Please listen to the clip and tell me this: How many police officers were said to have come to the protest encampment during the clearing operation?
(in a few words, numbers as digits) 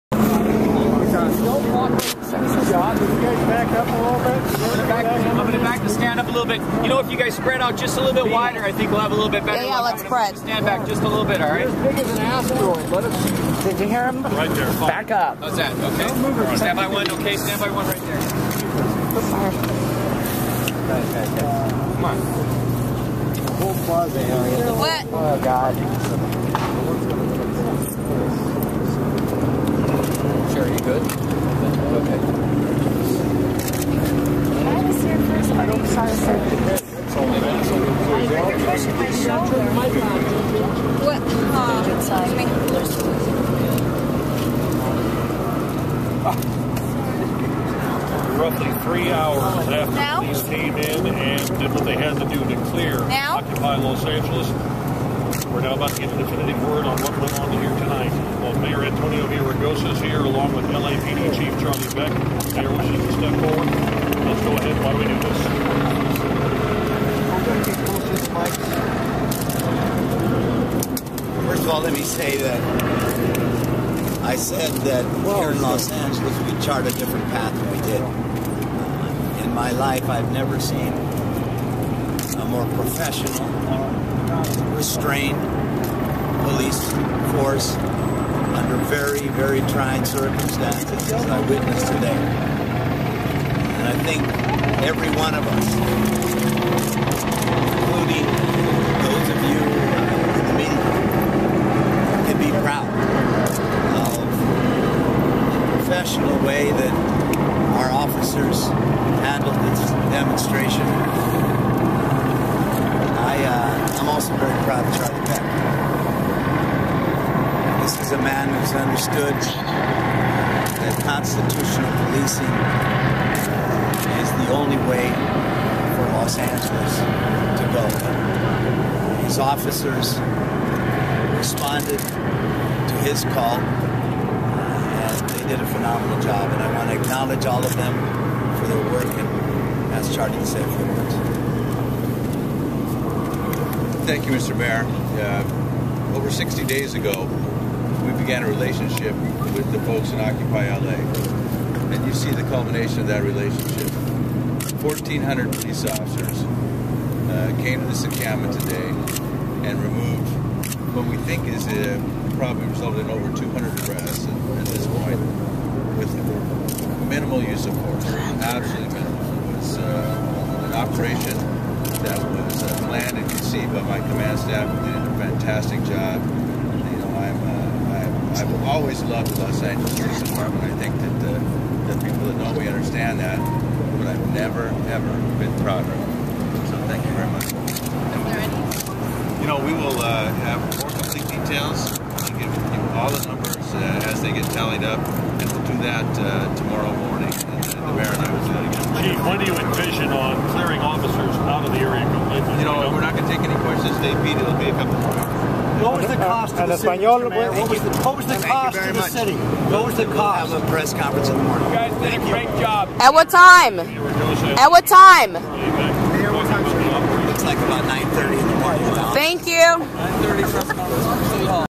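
1,400.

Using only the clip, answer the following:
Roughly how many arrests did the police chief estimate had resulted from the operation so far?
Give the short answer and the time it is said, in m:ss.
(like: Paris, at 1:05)
over 200, at 2:43.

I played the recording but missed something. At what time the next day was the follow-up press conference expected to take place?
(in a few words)
9:30 in the morning.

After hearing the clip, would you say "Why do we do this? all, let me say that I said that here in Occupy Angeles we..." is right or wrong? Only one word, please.
wrong.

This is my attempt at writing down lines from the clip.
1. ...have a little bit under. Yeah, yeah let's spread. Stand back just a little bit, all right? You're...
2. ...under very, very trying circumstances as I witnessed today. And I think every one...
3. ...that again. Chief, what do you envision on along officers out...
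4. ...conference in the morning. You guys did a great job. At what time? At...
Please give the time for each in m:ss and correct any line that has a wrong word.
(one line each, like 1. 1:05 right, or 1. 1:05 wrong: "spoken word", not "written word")
1. 0:09 wrong: "better", not "under"
2. 1:28 right
3. 3:18 wrong: "clearing", not "along"
4. 3:30 right.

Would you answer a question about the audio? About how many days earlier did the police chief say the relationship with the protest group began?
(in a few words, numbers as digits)
over 60 days.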